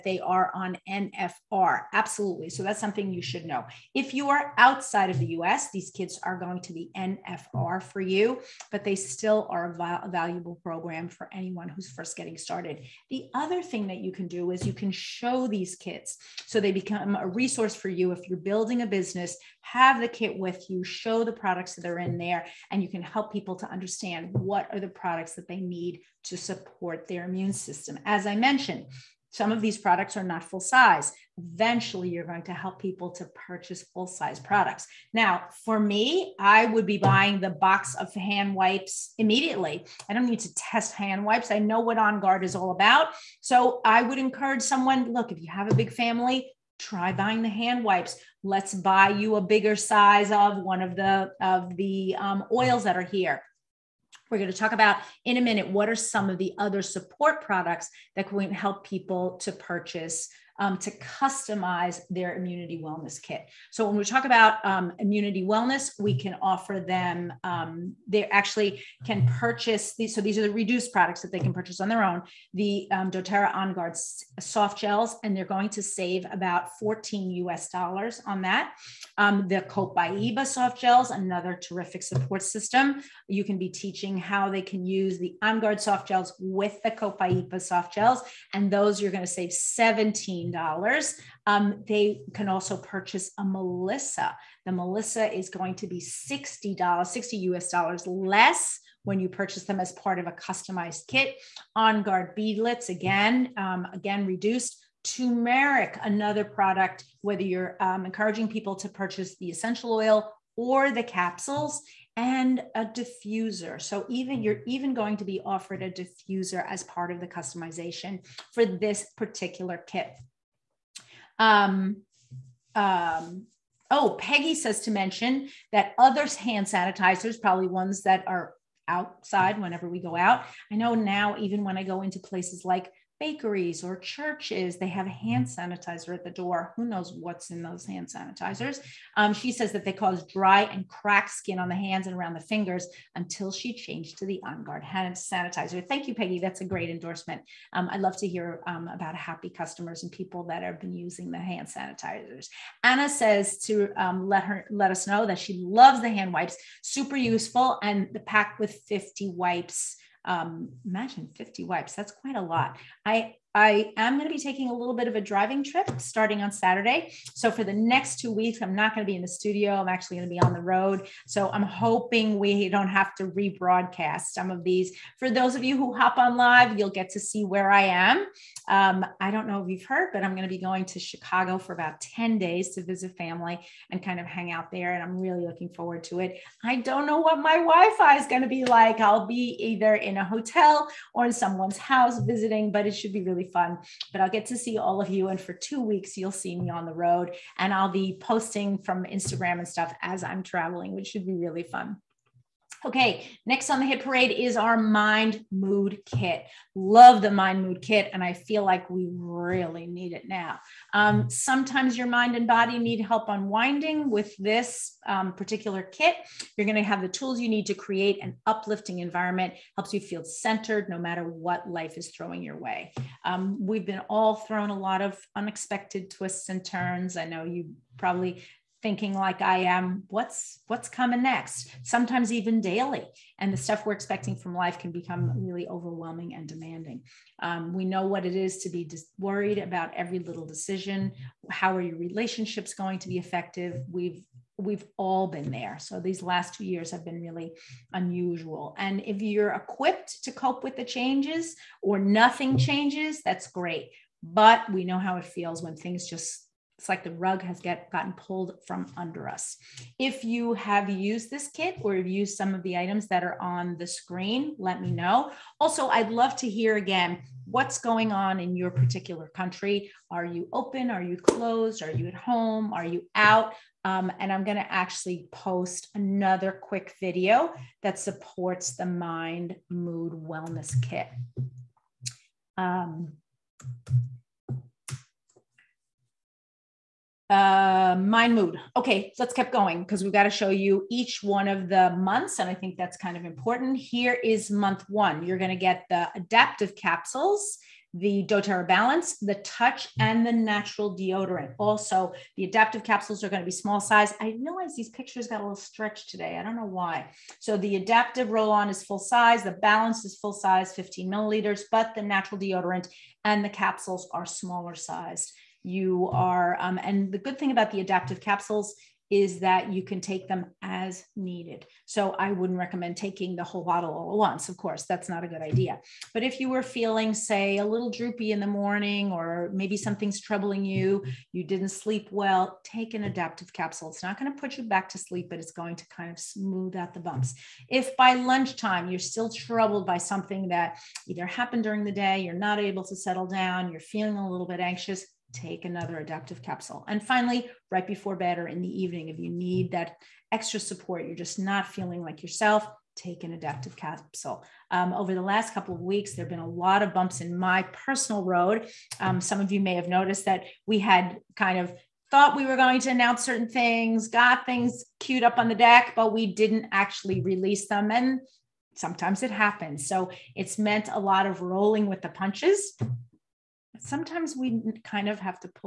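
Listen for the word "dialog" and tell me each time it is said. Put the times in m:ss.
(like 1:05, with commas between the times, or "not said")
not said.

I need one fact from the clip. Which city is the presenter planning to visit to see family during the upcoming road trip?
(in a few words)
Chicago.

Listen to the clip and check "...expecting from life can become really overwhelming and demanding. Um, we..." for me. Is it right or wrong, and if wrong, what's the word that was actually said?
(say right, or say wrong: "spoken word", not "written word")
right.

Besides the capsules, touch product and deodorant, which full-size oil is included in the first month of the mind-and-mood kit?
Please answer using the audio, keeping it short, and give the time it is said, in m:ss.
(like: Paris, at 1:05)
doTERRA Balance, at 4:58.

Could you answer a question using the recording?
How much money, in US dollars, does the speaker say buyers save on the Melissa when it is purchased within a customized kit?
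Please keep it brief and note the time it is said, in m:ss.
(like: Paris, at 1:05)
$60, at 1:37.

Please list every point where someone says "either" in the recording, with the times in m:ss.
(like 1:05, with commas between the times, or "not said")
3:09, 5:41.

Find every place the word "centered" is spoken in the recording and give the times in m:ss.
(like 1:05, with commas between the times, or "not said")
3:40.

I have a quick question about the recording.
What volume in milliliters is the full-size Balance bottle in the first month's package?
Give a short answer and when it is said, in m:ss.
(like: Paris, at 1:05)
15 milliliters, at 5:10.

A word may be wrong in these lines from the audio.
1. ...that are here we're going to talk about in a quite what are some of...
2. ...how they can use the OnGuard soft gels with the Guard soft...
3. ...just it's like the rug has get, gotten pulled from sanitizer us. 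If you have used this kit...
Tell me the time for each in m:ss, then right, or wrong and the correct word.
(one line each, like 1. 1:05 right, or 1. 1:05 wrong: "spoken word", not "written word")
1. 0:52 wrong: "minute", not "quite"
2. 1:24 wrong: "Copaiba", not "Guard"
3. 4:16 wrong: "under", not "sanitizer".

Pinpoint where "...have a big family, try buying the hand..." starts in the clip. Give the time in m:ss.
0:45.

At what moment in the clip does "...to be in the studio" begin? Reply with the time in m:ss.
2:49.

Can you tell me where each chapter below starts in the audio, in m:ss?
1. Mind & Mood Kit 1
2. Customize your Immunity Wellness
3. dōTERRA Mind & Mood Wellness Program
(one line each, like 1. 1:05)
1. 4:52
2. 1:05
3. 3:23.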